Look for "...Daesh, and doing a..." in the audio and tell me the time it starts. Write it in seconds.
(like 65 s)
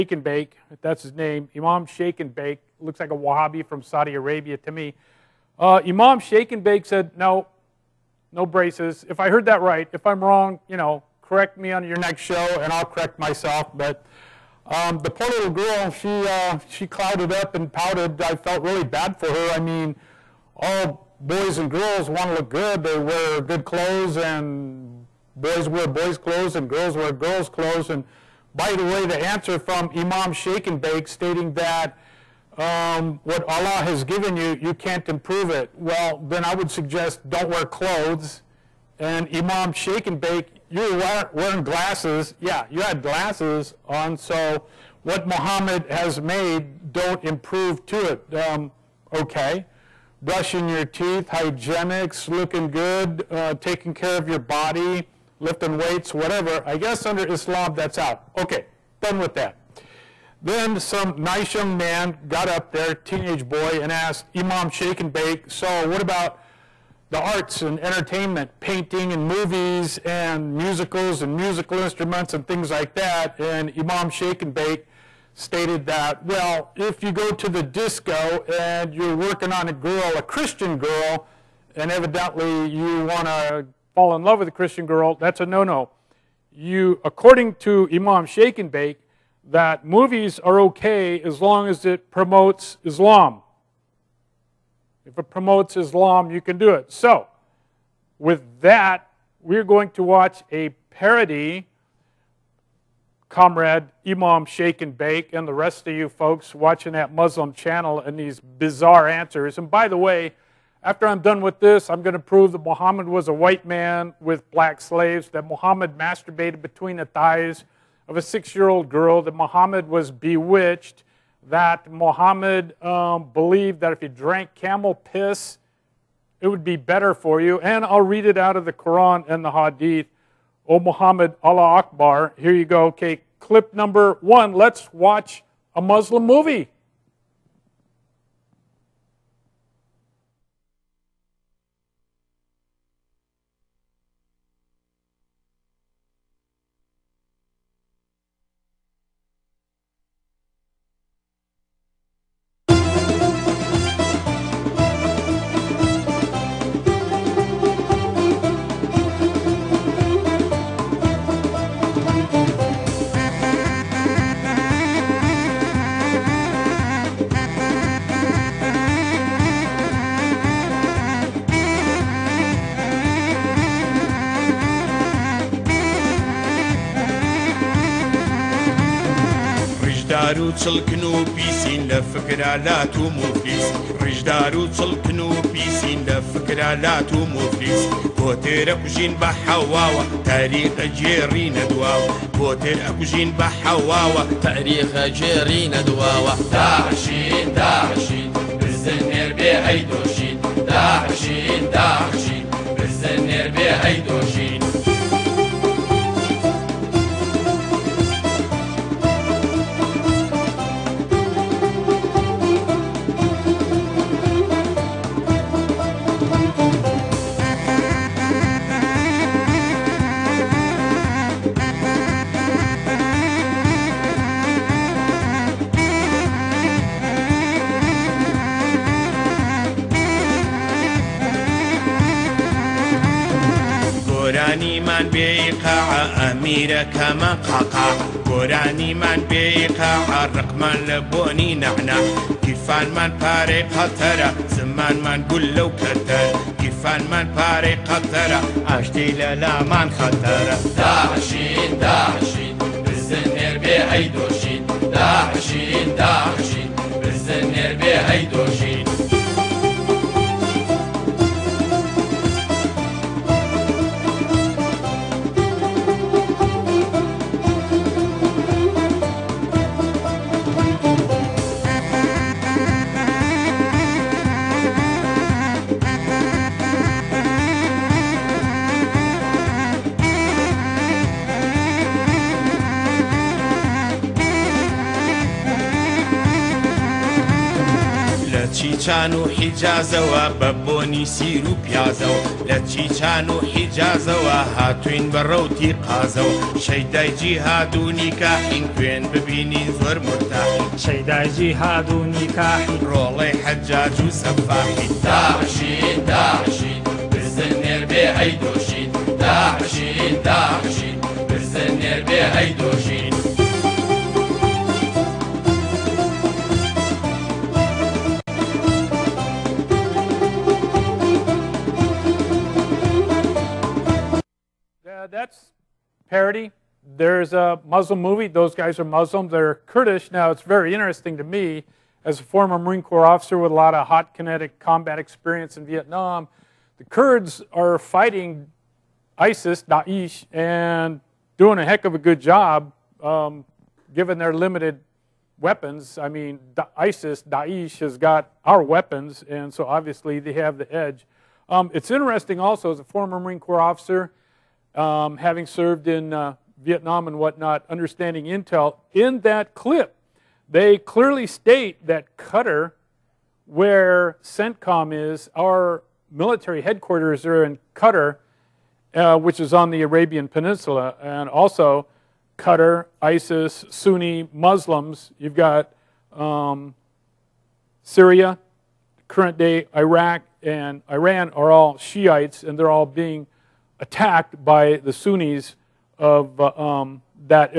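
339 s.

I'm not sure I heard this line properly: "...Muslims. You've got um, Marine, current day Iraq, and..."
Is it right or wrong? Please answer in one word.
wrong.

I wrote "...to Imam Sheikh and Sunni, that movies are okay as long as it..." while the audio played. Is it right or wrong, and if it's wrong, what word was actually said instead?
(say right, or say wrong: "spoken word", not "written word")
wrong: "Bake", not "Sunni".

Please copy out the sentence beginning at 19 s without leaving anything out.
I mean, all boys and girls want to look good.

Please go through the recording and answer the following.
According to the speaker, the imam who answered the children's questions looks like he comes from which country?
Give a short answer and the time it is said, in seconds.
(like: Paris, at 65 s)
Saudi Arabia, at 3 s.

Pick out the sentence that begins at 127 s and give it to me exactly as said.
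And I'll read it out of the Quran and the Hadith.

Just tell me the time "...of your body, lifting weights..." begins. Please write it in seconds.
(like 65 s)
54 s.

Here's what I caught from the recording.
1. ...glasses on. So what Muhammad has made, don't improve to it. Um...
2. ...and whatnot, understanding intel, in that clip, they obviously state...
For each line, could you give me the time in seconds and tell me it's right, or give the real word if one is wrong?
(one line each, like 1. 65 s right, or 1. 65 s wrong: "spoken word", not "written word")
1. 43 s right
2. 357 s wrong: "clearly", not "obviously".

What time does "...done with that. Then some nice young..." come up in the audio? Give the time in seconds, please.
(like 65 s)
59 s.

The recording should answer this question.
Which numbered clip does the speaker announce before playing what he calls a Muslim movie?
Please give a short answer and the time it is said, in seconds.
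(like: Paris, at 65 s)
Clip number 1, at 133 s.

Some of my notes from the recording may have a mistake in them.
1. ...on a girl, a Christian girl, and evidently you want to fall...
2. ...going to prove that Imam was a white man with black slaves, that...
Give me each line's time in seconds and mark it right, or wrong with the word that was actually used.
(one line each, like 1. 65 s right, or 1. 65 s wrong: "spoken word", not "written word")
1. 79 s right
2. 112 s wrong: "Muhammad", not "Imam".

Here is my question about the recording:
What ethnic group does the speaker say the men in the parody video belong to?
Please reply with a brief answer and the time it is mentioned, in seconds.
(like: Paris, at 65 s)
Kurdish, at 329 s.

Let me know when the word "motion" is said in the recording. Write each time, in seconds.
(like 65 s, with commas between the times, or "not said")
not said.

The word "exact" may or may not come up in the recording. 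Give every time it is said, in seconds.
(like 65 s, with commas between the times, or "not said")
not said.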